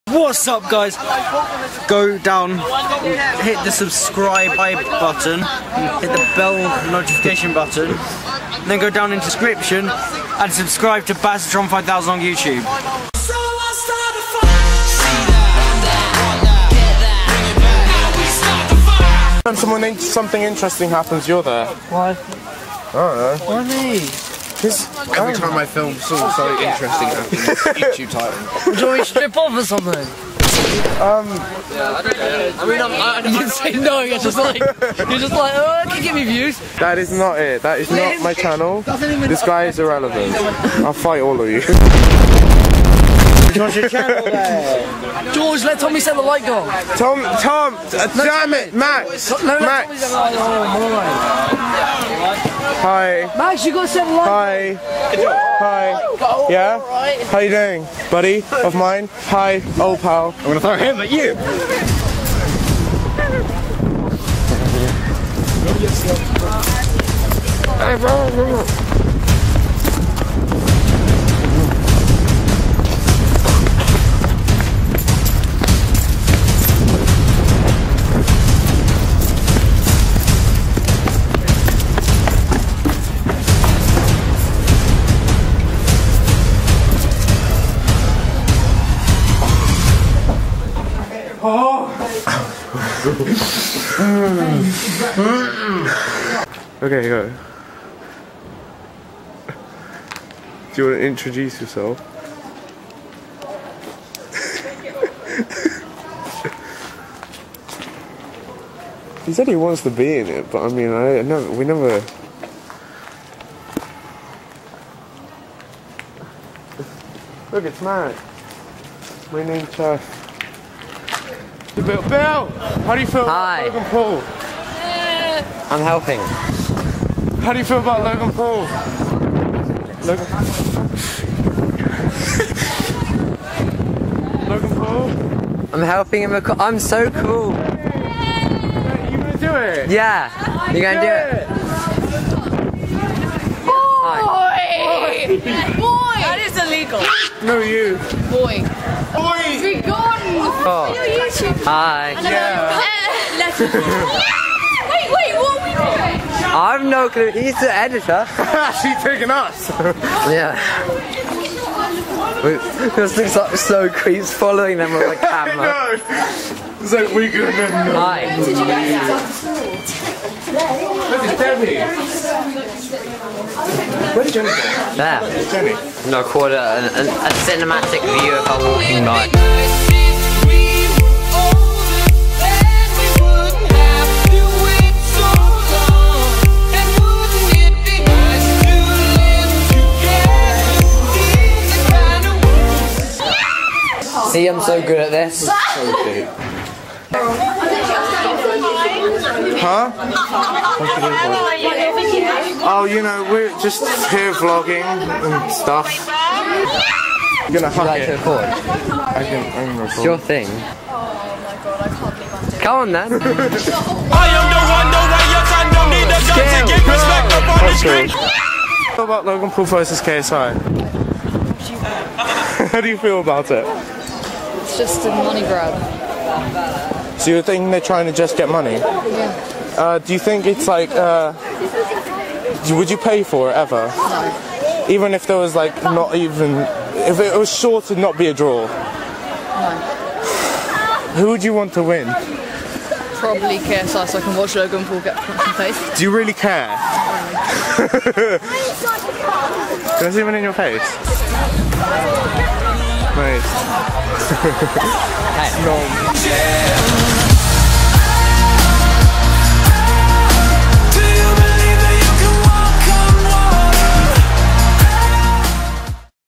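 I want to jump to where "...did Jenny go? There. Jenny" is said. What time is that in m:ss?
2:54.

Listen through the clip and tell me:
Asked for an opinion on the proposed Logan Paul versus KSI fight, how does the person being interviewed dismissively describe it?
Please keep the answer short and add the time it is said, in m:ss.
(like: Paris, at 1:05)
a money grab, at 3:45.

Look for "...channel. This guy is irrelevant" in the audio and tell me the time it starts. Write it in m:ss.
0:38.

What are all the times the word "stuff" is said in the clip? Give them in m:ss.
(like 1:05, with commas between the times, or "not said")
3:25.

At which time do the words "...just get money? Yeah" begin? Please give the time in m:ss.
3:48.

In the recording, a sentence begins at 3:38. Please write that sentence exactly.
How about Logan Paul versus KSI?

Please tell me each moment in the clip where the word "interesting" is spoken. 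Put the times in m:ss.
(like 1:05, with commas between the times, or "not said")
0:20, 0:26.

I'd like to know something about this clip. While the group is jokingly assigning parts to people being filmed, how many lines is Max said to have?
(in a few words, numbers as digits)
7.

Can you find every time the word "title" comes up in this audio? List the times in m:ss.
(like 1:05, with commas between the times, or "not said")
0:28.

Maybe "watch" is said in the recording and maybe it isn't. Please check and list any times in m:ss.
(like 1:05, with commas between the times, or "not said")
4:04.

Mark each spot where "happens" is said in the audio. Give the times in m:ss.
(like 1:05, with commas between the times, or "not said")
0:20, 0:27.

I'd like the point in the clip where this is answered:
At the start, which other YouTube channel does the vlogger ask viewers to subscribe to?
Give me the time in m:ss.
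0:11.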